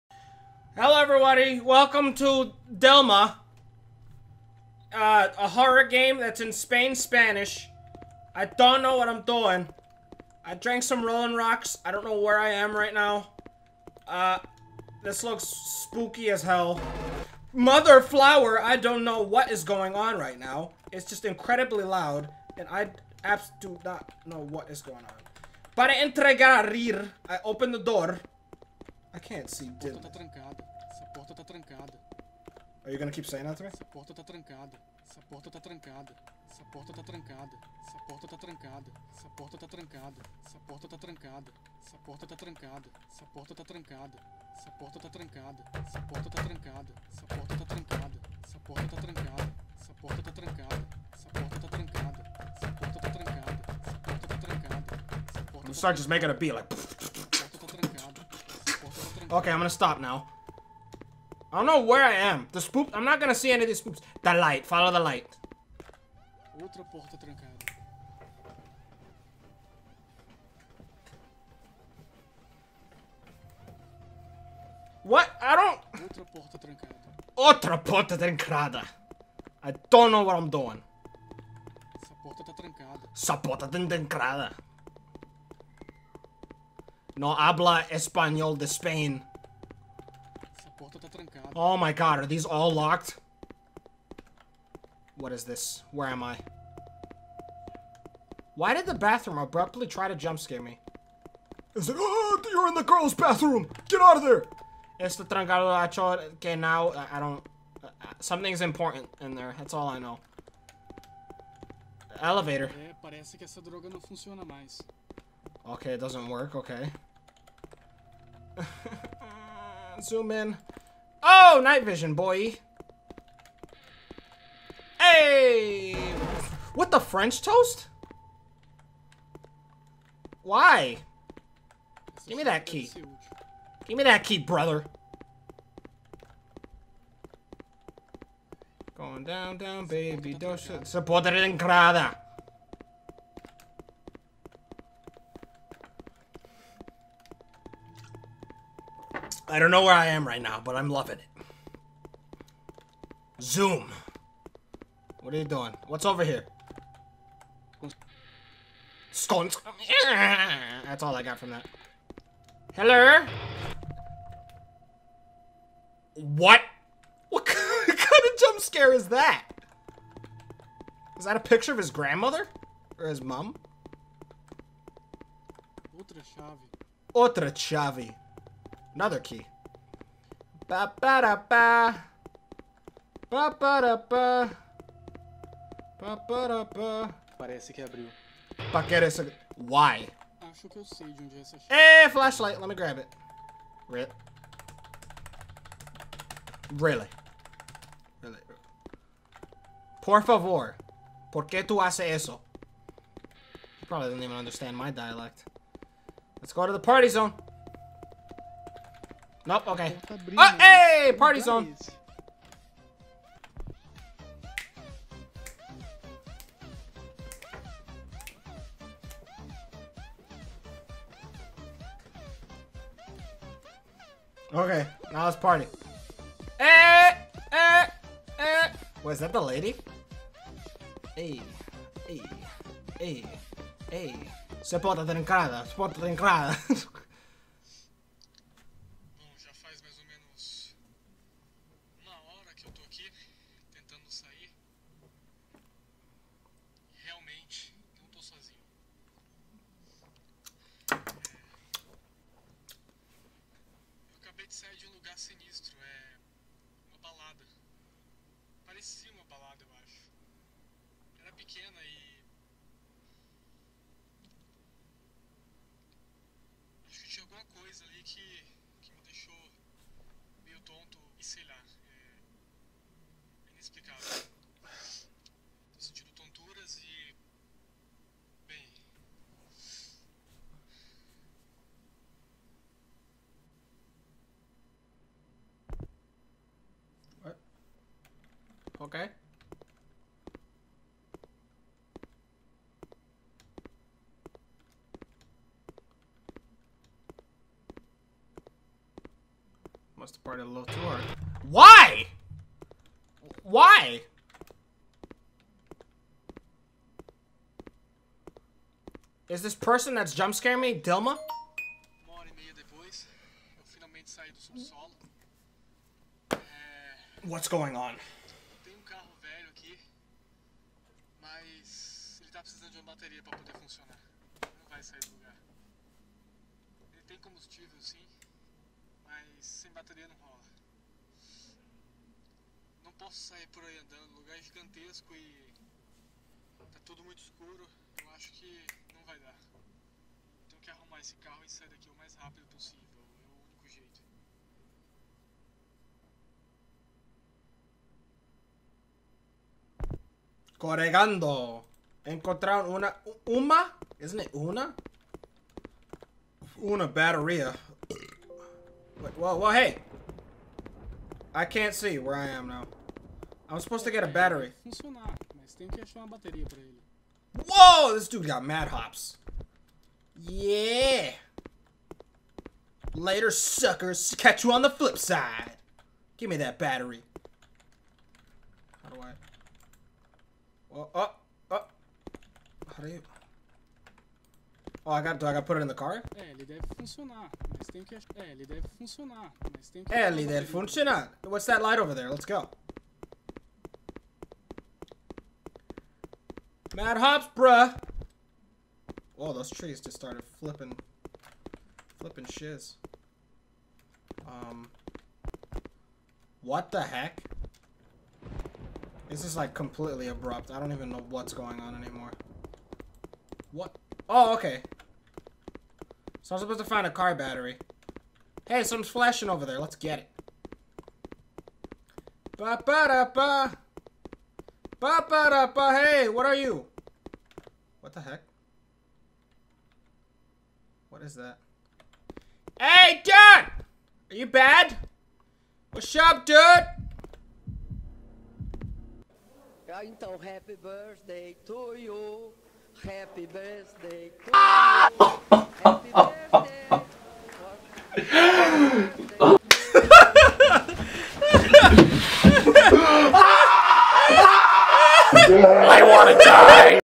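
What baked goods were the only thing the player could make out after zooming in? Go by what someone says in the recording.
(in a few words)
Scones.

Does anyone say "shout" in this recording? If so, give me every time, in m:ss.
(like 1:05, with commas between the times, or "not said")
not said.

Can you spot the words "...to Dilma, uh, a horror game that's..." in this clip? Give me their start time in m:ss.
0:02.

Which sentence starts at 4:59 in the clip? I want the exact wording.
Must have parted a little too hard.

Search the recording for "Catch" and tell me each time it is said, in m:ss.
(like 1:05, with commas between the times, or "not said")
6:14.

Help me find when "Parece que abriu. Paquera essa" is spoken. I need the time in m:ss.
3:07.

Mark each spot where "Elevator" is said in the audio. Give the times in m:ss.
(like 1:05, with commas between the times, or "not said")
1:52.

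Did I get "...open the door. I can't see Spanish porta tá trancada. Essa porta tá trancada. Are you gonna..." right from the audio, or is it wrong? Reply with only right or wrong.
wrong.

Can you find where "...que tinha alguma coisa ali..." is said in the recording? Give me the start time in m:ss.
4:27.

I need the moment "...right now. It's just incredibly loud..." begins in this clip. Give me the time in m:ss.
0:20.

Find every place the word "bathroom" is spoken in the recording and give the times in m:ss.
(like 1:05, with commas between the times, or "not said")
1:38, 1:43.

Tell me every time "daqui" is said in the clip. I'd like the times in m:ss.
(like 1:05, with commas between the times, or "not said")
5:41.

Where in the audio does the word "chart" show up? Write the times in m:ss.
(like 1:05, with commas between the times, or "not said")
not said.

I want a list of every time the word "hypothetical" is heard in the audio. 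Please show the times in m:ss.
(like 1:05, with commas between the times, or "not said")
not said.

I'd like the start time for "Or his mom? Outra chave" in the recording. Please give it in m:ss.
2:52.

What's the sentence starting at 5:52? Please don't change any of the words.
Encontraram uma, uma, isn't it una?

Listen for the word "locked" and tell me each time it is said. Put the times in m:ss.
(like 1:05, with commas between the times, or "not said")
1:32.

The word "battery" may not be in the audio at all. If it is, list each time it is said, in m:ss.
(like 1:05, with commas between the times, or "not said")
6:04, 6:16, 6:57.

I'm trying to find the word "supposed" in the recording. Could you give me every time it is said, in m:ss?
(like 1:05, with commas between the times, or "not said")
6:03, 6:56.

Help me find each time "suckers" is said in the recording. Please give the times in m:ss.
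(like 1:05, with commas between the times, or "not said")
6:13.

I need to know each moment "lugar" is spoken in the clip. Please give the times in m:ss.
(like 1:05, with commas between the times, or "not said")
4:14, 5:25, 5:34.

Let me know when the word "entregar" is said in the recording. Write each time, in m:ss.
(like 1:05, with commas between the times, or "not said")
0:25.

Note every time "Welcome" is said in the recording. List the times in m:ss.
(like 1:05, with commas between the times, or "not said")
0:01.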